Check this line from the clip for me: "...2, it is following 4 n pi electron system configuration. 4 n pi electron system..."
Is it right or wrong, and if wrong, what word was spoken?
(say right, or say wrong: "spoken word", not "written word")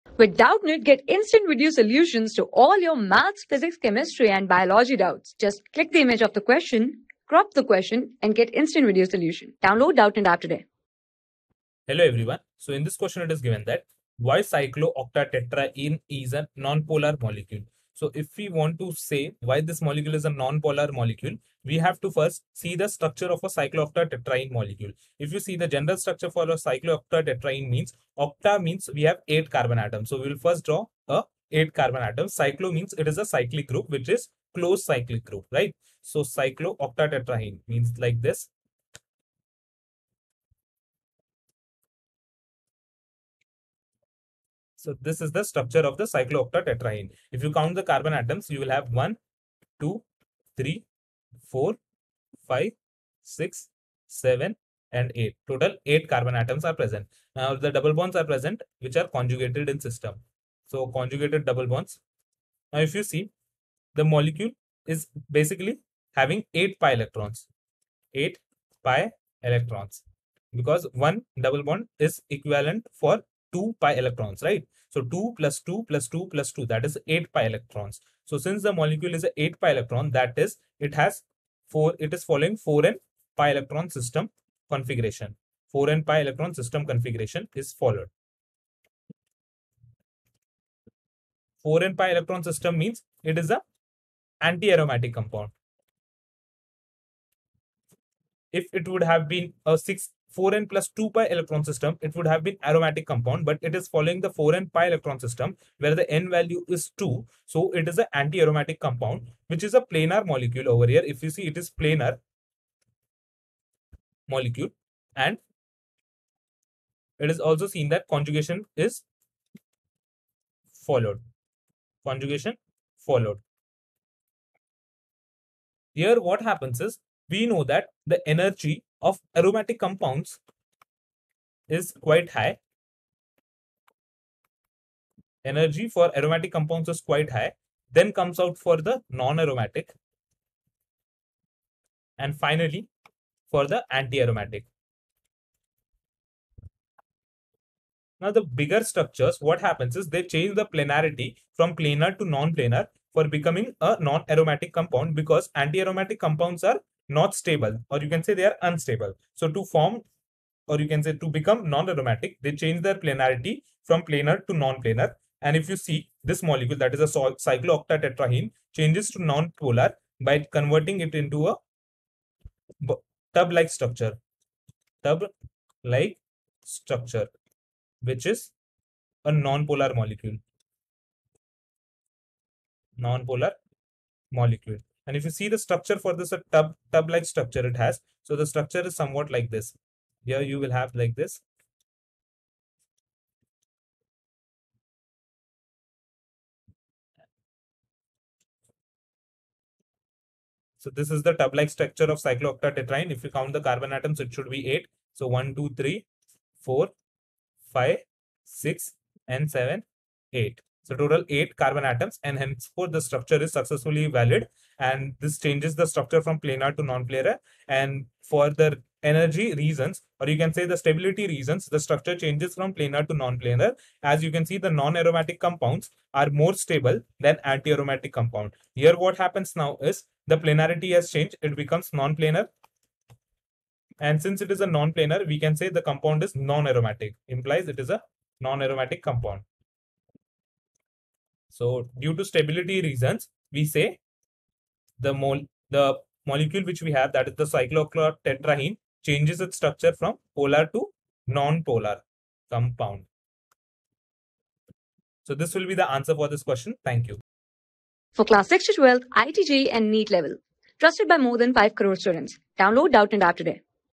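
wrong: "4", not "2".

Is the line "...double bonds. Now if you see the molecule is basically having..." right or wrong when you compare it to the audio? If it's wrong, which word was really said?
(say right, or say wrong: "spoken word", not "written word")
right.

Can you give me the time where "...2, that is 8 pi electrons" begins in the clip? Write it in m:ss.
1:16.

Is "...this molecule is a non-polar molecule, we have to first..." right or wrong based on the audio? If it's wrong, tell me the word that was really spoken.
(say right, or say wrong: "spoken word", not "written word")
right.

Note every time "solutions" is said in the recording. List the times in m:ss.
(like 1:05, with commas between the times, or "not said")
0:01, 0:09.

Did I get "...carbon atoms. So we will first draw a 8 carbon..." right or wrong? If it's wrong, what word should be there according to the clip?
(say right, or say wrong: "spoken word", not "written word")
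right.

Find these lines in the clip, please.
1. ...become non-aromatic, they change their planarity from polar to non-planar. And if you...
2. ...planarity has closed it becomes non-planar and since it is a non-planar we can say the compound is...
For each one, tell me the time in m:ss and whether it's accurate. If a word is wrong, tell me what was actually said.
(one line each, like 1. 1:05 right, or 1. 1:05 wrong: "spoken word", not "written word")
1. 2:41 wrong: "planar", not "polar"
2. 3:50 wrong: "changed", not "closed".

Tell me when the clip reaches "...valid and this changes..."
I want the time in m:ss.
3:34.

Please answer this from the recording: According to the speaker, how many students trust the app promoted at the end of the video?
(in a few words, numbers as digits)
More than 5 crore.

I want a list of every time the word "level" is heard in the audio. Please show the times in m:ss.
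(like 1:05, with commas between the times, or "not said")
4:20.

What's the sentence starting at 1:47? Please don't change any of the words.
So it is an anti-aromatic compound, which is a planar molecule over here.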